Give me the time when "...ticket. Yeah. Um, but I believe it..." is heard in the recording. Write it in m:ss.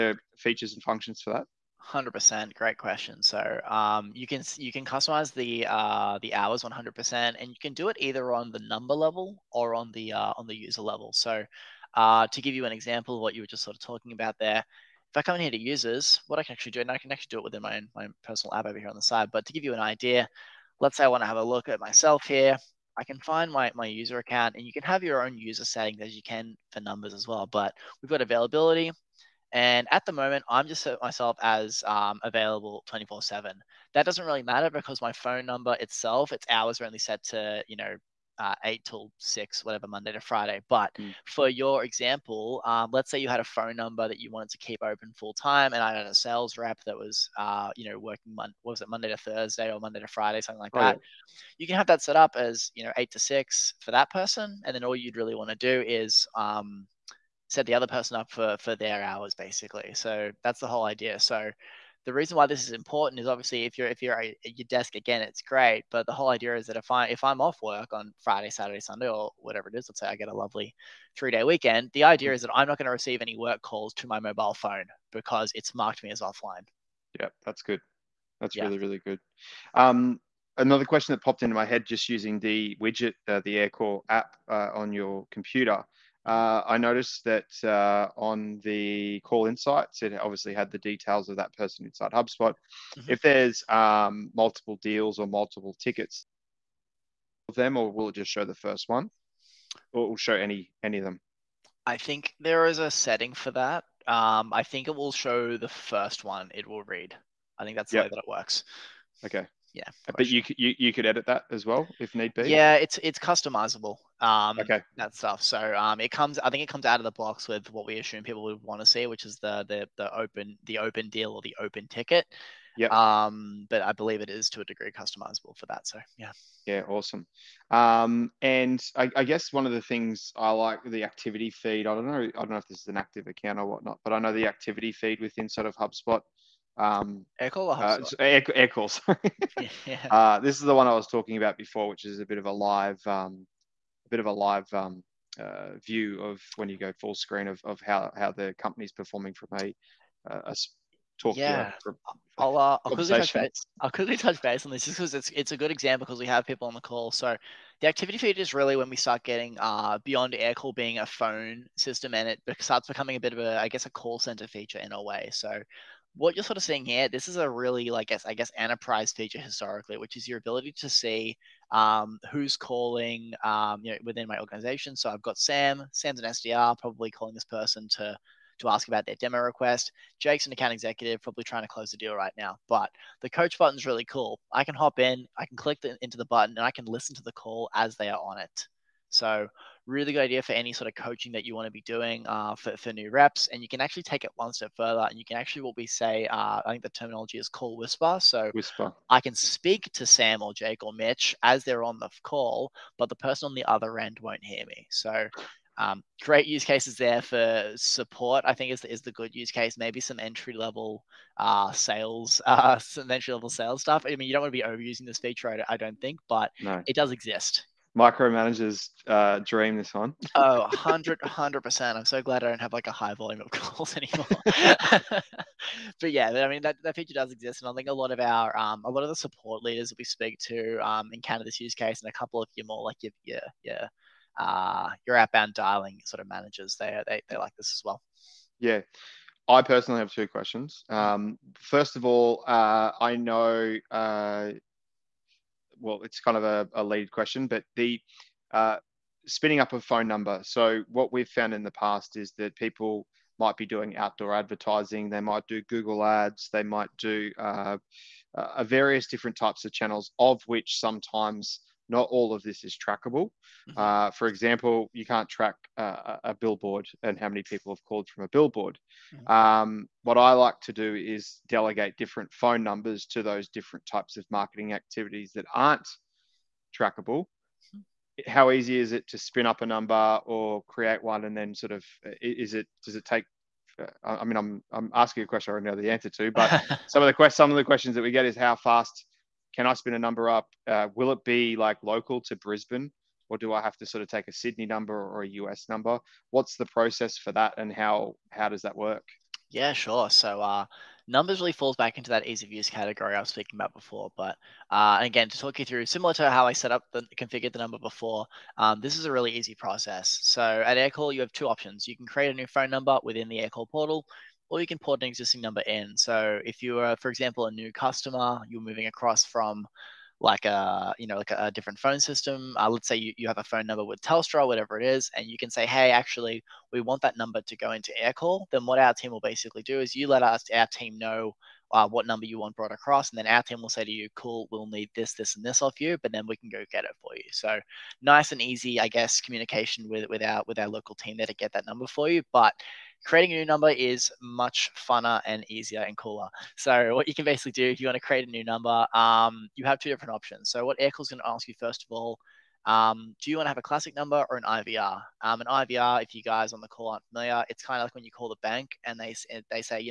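2:01.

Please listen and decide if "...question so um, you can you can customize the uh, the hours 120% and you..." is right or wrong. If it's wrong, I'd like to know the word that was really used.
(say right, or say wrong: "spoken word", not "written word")
wrong: "100", not "120".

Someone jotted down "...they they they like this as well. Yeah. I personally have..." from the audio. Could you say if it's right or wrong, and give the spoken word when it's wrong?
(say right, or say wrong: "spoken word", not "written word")
right.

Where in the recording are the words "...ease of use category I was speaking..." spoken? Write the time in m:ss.
5:02.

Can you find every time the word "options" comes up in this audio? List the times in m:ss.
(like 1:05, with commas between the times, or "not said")
5:11, 5:50.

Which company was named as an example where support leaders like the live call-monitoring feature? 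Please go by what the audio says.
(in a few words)
Canva.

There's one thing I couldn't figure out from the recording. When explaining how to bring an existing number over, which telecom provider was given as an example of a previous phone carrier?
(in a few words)
Telstra.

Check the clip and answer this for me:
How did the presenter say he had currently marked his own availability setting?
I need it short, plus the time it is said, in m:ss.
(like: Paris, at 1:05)
24/7, at 0:32.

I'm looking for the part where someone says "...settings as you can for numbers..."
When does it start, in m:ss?
0:25.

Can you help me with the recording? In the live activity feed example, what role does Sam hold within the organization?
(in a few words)
SDR.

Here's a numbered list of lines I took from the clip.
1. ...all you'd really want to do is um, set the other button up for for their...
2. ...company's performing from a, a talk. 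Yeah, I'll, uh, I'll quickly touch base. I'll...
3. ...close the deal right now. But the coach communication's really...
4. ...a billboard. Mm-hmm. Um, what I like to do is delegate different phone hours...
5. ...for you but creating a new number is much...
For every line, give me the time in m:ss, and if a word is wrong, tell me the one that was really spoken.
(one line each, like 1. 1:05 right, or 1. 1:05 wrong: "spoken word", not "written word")
1. 0:54 wrong: "person", not "button"
2. 2:28 right
3. 3:01 wrong: "button", not "communication"
4. 4:28 wrong: "numbers", not "hours"
5. 5:41 right.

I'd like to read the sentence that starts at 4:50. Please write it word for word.
Uh, will it be like local to Brisbane?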